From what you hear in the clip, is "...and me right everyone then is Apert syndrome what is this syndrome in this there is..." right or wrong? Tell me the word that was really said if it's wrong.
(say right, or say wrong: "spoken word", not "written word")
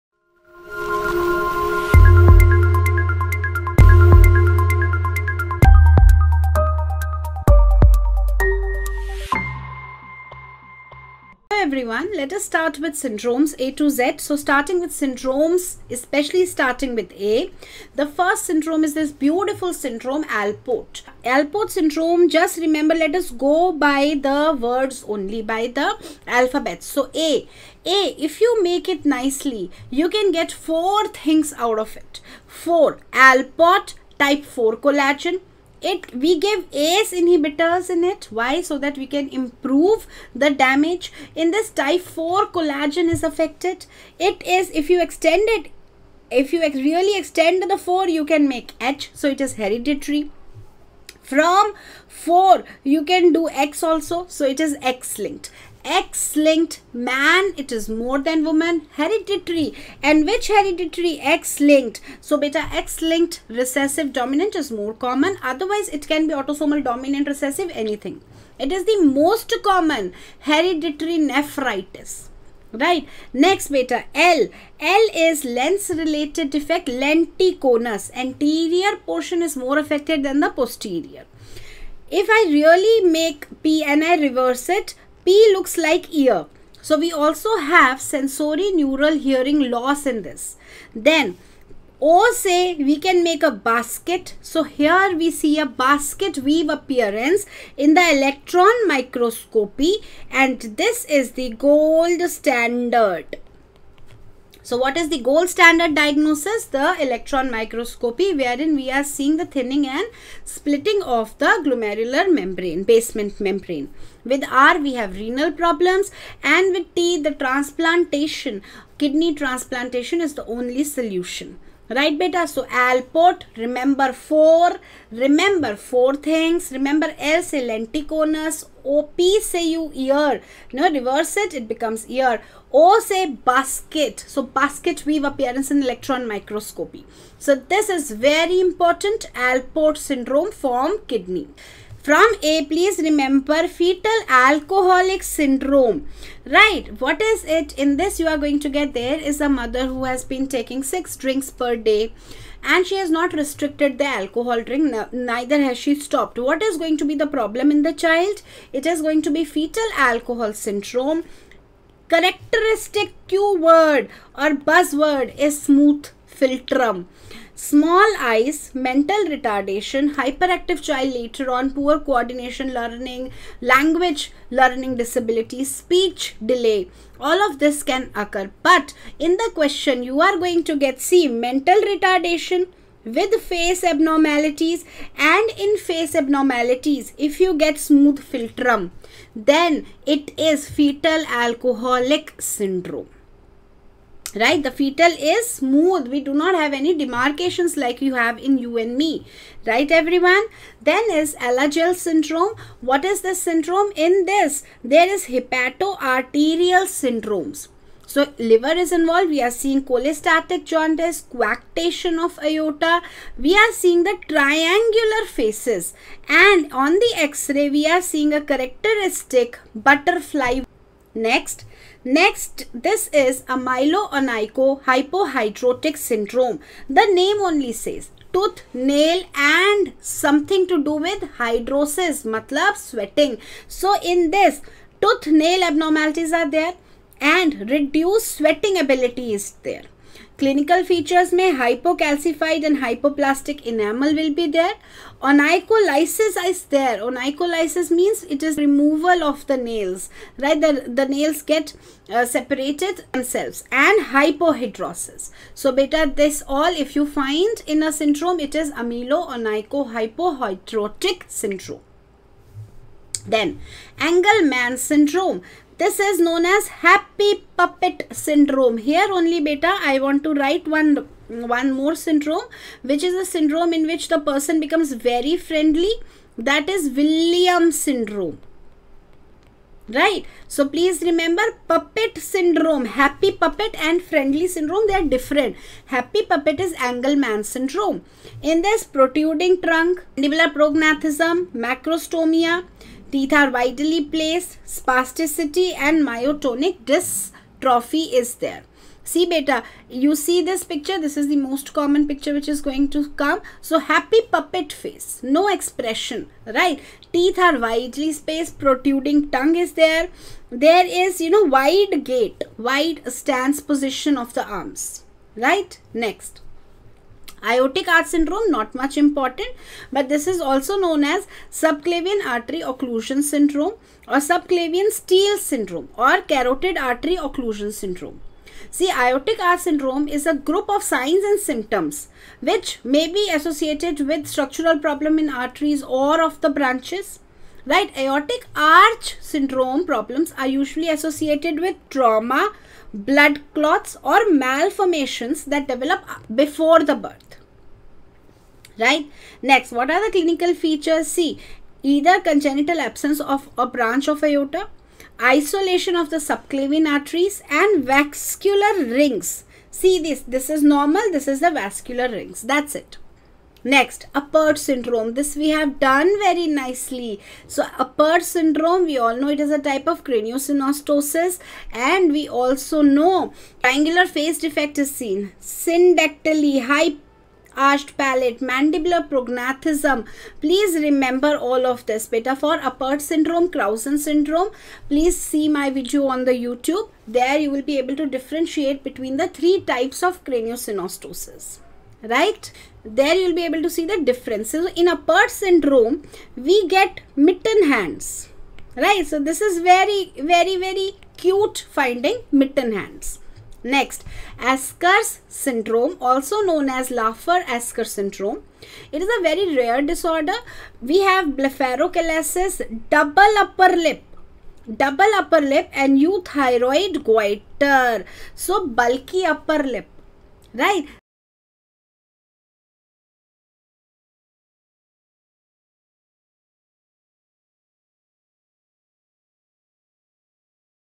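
wrong: "Alagille", not "Apert".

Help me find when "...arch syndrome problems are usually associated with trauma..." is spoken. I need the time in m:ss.
5:38.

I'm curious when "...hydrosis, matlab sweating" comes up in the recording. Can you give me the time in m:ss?
3:51.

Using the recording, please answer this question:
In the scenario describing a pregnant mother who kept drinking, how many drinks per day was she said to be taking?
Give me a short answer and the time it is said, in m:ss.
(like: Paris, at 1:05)
6, at 2:30.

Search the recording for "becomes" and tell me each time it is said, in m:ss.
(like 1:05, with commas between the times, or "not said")
2:11, 4:34.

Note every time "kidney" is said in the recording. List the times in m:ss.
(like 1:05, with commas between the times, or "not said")
1:59, 2:21.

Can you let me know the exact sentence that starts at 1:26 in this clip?
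So we also have sensory neural hearing loss in this.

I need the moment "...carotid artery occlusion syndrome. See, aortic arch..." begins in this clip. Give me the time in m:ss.
5:26.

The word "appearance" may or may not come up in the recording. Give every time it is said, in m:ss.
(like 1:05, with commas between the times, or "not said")
1:36, 2:15.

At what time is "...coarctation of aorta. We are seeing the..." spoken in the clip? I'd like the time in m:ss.
3:31.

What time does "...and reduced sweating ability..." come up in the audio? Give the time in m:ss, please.
3:57.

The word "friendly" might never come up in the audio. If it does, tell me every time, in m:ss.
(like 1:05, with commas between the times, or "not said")
4:35, 4:44.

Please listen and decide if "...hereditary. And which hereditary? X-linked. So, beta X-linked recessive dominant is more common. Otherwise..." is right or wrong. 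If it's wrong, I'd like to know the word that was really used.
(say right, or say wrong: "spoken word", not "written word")
right.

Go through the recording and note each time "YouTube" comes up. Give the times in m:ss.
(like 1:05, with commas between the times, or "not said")
6:26.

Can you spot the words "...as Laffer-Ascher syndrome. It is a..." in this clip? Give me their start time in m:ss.
6:46.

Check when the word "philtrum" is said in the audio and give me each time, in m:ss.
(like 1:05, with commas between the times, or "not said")
2:46, 3:08.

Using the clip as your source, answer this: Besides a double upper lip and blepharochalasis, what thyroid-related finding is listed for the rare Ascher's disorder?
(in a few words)
Euthyroid goiter.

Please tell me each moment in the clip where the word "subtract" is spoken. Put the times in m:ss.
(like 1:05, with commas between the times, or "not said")
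not said.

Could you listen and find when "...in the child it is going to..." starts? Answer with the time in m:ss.
2:37.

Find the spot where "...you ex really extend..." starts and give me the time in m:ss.
0:46.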